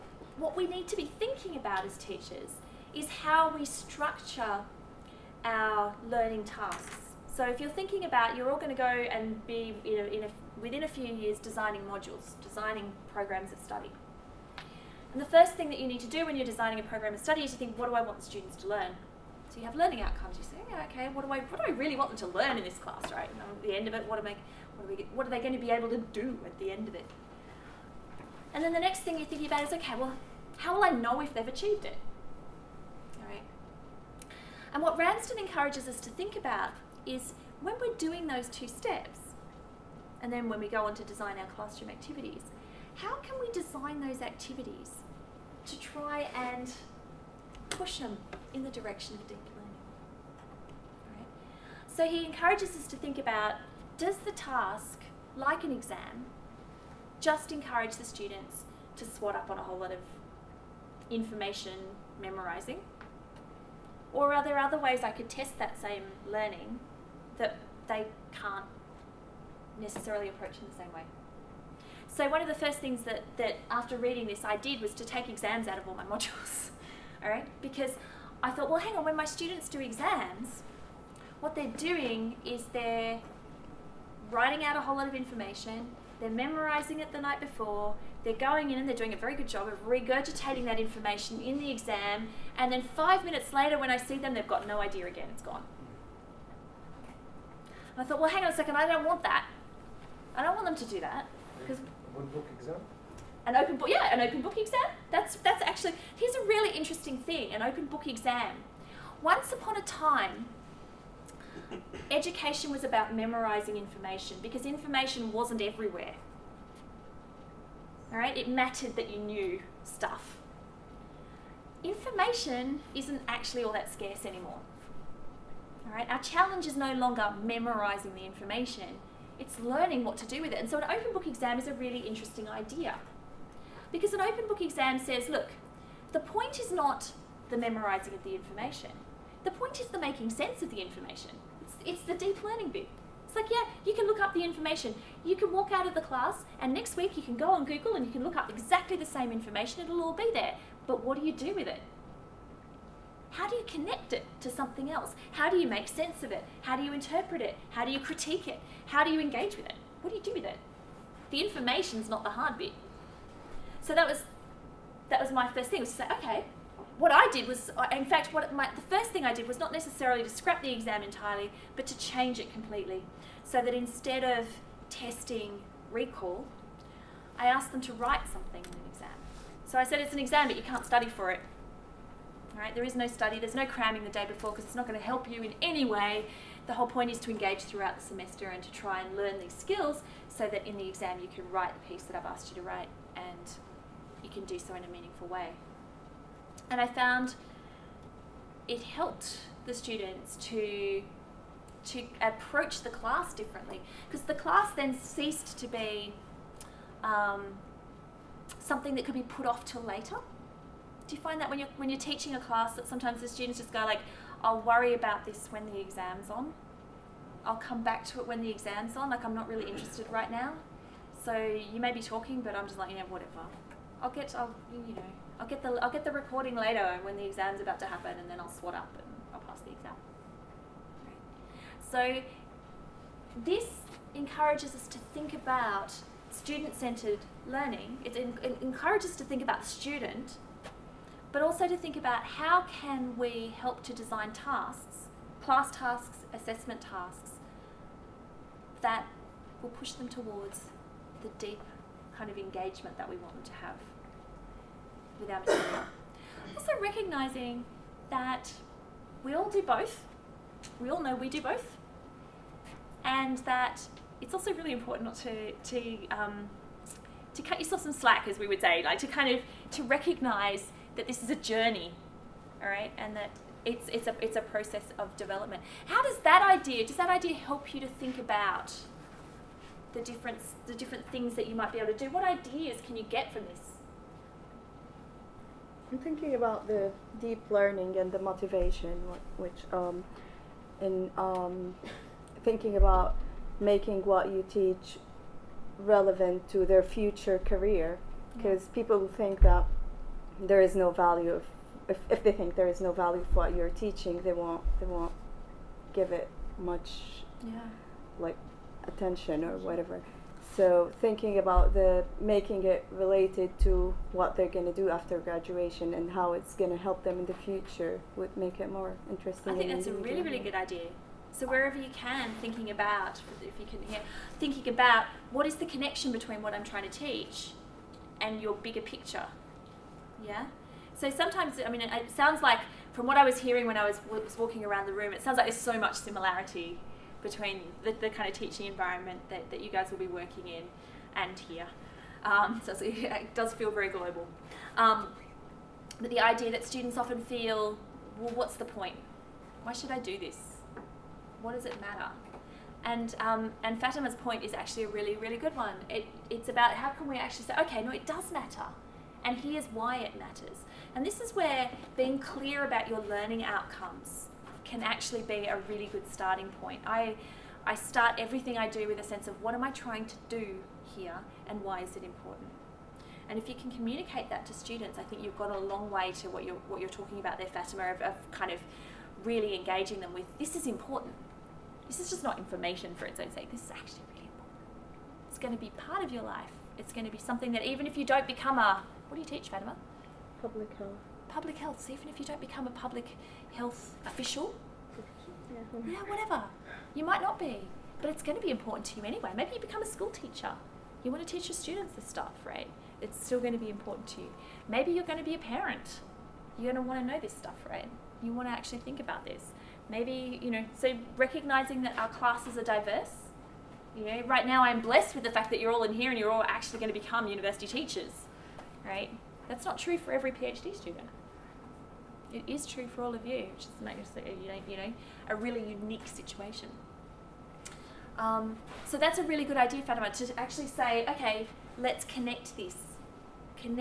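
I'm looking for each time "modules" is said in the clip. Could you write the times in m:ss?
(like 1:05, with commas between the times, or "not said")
0:11, 1:16.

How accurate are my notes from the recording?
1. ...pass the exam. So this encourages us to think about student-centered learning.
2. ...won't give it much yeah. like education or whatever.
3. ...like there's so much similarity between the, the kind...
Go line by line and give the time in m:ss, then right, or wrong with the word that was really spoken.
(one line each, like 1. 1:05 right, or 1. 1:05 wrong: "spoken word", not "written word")
1. 3:49 right
2. 5:04 wrong: "attention", not "education"
3. 5:35 right.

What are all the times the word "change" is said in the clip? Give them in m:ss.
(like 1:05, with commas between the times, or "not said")
2:51.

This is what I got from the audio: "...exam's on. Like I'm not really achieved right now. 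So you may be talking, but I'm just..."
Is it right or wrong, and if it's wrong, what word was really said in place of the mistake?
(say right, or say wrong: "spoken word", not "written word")
wrong: "interested", not "achieved".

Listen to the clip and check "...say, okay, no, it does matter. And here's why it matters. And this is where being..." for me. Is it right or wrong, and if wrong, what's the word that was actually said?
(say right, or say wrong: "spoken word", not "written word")
right.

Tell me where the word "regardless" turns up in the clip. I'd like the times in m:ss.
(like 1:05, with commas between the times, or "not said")
not said.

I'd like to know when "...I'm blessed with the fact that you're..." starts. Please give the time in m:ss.
6:54.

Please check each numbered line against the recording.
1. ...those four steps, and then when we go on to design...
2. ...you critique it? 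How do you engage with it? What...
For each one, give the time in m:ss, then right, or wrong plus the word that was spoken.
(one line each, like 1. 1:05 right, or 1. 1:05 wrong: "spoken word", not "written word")
1. 0:38 wrong: "two", not "four"
2. 2:37 right.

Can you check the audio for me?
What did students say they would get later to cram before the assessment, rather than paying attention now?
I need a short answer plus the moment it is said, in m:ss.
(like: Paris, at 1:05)
The recording, at 3:46.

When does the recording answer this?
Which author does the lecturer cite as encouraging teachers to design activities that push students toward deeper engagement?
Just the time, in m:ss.
0:34.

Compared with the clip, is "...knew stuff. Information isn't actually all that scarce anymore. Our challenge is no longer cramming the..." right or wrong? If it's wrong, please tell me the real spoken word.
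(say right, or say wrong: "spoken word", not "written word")
wrong: "memorizing", not "cramming".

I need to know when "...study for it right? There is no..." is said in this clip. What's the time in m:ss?
3:00.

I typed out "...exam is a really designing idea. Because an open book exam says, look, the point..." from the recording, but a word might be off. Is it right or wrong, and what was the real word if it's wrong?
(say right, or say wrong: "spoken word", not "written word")
wrong: "interesting", not "designing".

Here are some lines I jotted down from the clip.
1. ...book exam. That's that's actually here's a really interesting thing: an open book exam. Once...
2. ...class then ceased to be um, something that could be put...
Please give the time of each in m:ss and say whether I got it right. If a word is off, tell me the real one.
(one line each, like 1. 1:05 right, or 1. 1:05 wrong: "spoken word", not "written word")
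1. 1:44 right
2. 3:24 right.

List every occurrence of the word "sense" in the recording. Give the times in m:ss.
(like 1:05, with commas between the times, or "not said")
2:20, 2:35, 6:09.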